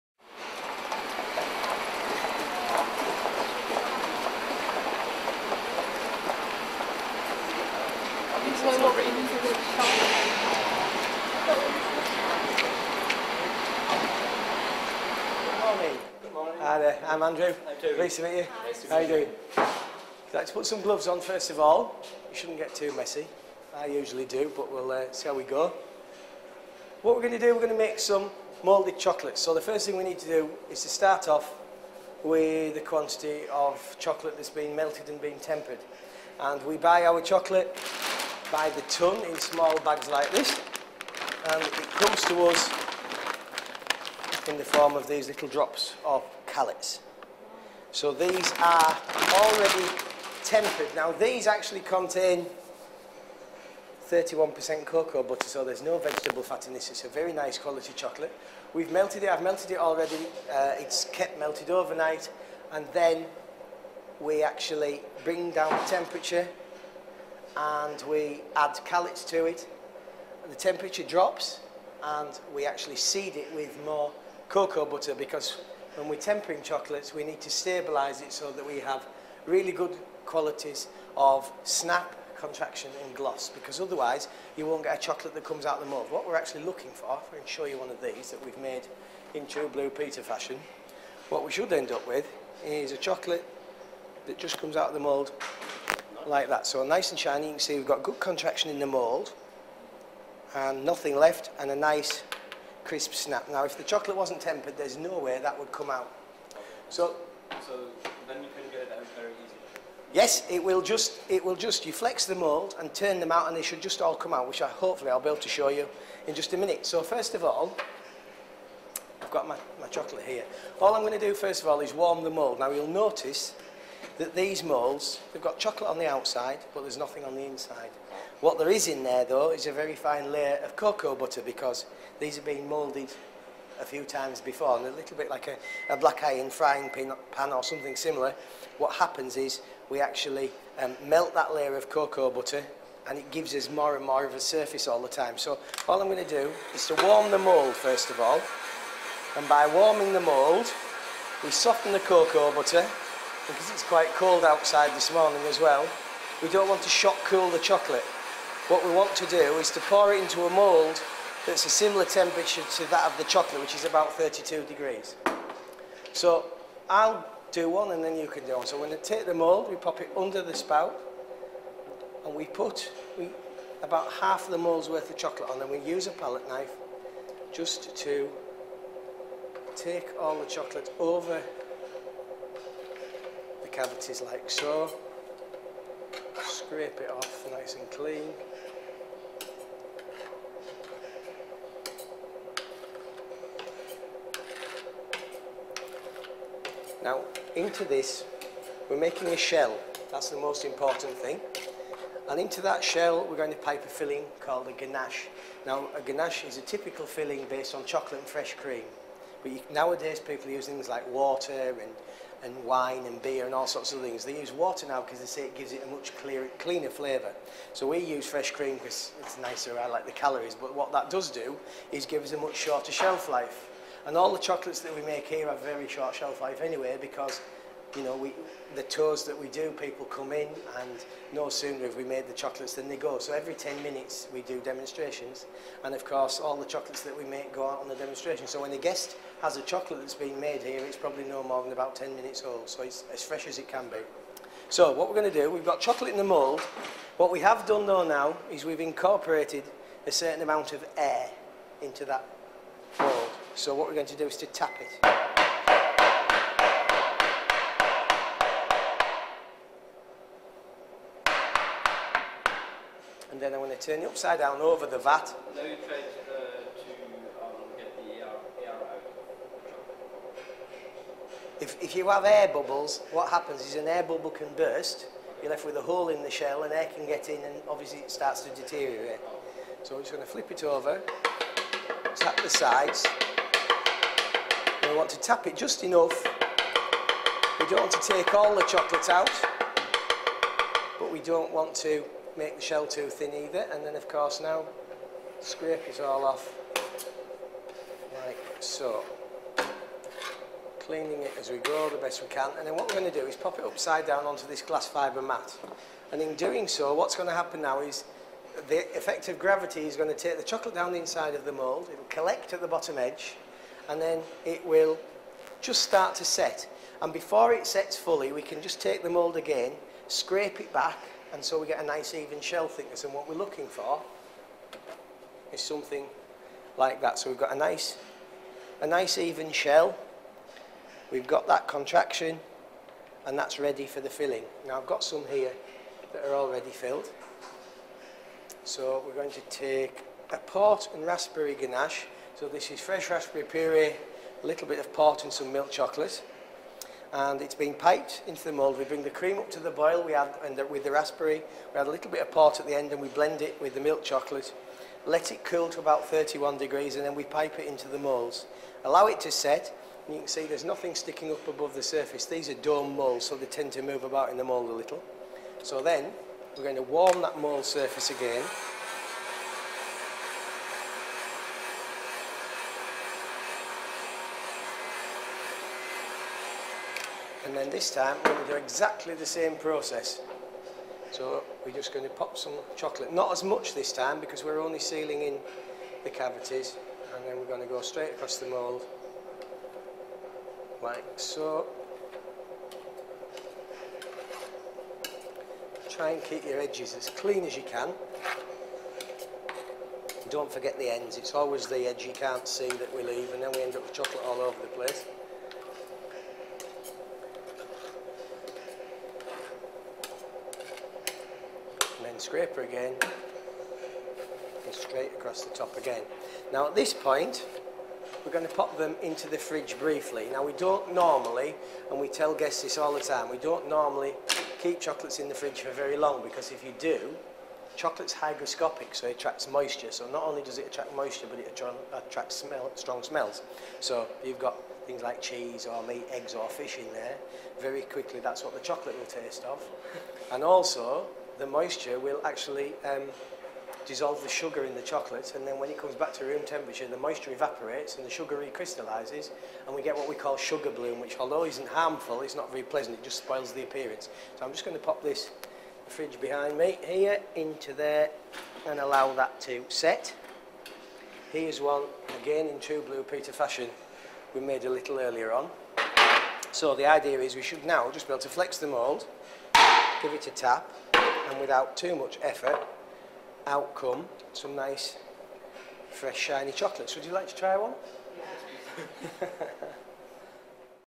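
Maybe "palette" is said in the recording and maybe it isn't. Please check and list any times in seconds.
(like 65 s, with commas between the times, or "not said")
176 s.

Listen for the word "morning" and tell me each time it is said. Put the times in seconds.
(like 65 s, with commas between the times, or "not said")
16 s, 155 s.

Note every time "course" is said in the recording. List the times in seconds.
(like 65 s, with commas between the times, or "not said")
236 s, 294 s.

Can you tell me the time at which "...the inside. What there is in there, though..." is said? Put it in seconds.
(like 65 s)
127 s.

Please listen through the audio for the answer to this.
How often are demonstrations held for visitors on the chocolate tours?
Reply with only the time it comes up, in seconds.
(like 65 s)
233 s.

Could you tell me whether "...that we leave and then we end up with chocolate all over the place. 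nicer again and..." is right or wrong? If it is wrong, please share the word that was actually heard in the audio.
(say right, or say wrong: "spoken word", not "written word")
wrong: "scraper", not "nicer".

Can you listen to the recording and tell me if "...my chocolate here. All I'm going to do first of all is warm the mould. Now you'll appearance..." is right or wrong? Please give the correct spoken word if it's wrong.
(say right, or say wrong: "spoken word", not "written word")
wrong: "notice", not "appearance".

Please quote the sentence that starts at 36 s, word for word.
And we buy our chocolate by the ton in small bags like this.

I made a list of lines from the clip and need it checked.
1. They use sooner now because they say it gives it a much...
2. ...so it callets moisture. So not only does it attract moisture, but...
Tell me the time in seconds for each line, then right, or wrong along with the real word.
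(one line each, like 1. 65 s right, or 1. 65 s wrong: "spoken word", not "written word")
1. 214 s wrong: "water", not "sooner"
2. 428 s wrong: "attracts", not "callets".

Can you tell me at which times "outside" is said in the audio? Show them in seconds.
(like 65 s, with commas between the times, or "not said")
126 s, 154 s.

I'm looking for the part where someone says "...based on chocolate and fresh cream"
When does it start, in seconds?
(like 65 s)
207 s.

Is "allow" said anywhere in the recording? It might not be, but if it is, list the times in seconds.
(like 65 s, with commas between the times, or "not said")
358 s, 458 s.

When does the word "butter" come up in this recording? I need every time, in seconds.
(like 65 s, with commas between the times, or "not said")
55 s, 74 s, 131 s, 142 s, 152 s.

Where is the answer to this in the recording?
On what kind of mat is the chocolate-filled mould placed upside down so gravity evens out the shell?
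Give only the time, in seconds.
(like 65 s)
304 s.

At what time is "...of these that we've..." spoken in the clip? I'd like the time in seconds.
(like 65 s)
87 s.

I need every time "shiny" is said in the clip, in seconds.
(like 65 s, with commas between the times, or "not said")
97 s, 476 s.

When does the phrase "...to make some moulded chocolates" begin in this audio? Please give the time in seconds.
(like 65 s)
27 s.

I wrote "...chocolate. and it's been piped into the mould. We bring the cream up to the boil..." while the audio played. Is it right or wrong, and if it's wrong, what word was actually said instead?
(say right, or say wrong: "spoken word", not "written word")
right.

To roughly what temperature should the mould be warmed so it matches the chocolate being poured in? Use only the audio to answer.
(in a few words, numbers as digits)
32 degrees.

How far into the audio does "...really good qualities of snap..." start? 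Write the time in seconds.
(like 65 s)
79 s.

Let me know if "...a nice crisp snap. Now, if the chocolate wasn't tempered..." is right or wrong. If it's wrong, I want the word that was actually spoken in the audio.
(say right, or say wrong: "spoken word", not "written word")
right.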